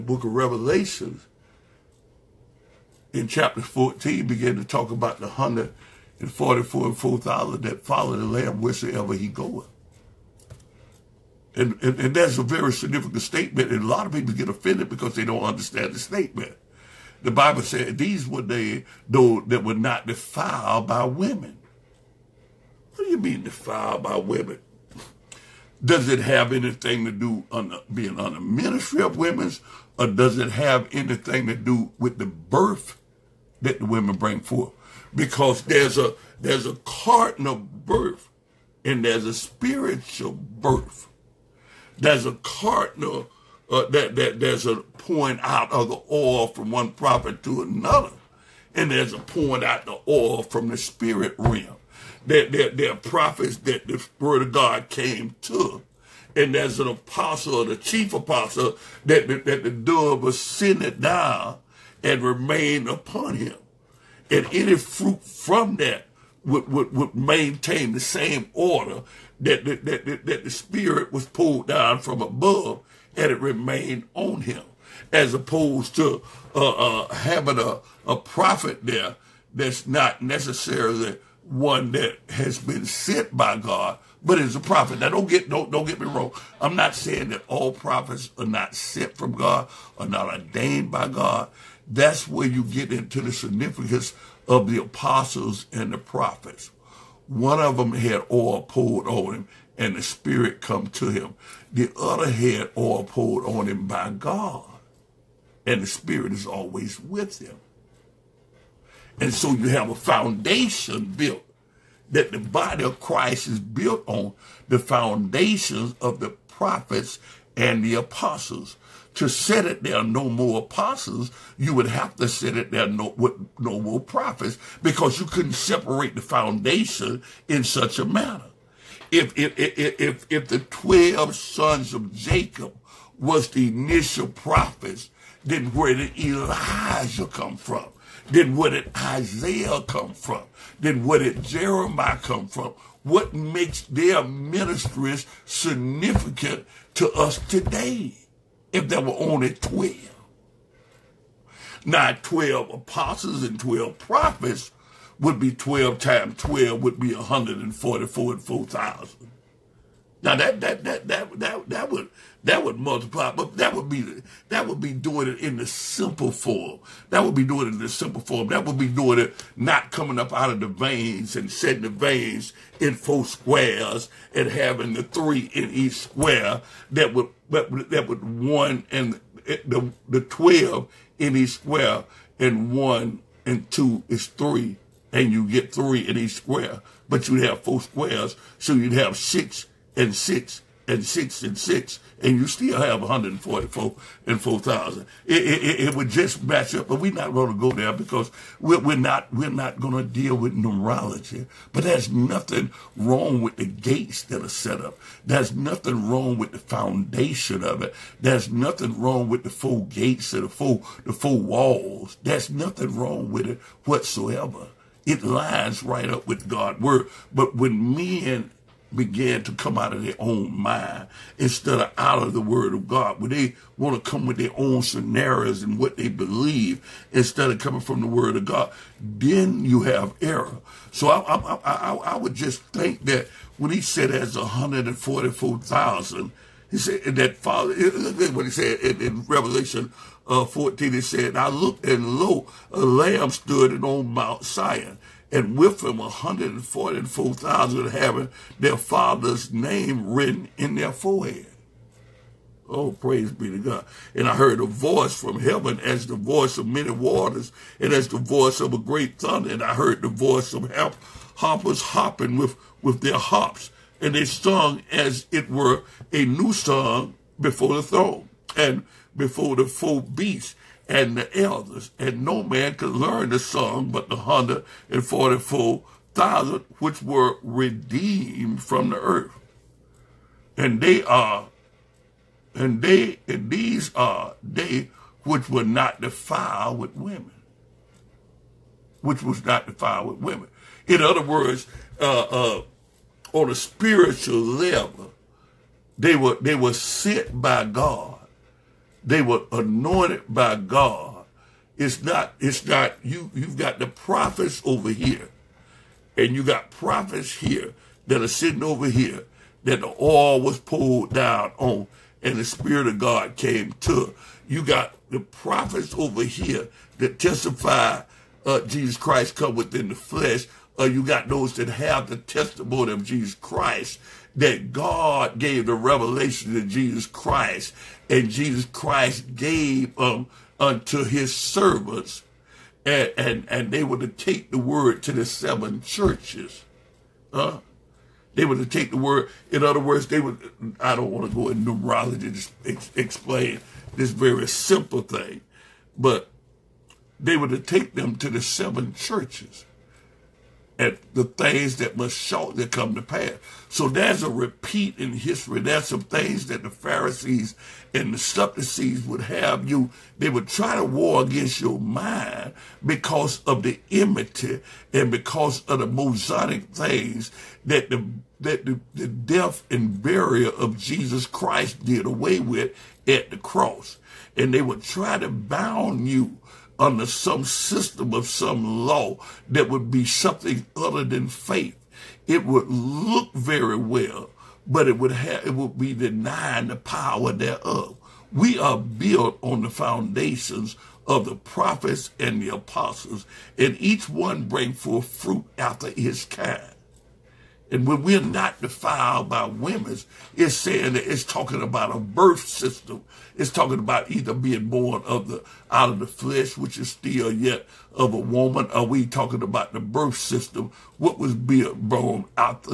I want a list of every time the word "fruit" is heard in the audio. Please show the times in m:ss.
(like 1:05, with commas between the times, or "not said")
1:04, 6:35.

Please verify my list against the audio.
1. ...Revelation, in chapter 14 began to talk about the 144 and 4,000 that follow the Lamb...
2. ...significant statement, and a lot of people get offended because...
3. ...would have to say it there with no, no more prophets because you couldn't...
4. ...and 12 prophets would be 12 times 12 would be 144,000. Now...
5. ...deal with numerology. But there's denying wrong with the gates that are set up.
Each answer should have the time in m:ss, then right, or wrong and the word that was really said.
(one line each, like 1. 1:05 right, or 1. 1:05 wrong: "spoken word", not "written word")
1. 0:00 right
2. 0:12 right
3. 2:01 right
4. 2:33 right
5. 3:20 wrong: "nothing", not "denying".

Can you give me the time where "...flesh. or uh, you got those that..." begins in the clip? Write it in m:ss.
5:19.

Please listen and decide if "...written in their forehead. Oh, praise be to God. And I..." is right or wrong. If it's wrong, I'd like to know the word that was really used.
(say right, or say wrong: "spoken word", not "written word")
right.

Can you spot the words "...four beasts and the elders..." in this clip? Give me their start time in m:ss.
4:29.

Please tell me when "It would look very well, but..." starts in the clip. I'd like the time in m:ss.
6:22.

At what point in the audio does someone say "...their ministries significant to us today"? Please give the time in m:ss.
2:23.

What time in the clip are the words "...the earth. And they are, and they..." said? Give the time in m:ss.
4:38.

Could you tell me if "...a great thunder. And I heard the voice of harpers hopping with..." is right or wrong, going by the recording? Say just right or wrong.
right.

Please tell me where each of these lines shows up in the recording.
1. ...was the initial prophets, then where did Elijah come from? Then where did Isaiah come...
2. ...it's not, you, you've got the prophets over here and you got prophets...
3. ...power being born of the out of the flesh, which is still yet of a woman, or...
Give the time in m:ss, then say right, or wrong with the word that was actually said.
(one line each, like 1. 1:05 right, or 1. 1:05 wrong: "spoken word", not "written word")
1. 2:13 right
2. 5:02 right
3. 6:44 wrong: "either", not "power".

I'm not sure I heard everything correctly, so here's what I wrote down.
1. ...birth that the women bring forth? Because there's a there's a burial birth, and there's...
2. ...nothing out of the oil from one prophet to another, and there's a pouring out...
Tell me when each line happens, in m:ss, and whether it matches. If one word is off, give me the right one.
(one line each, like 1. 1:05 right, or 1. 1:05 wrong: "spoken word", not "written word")
1. 0:32 wrong: "carnal", not "burial"
2. 0:44 wrong: "pouring", not "nothing".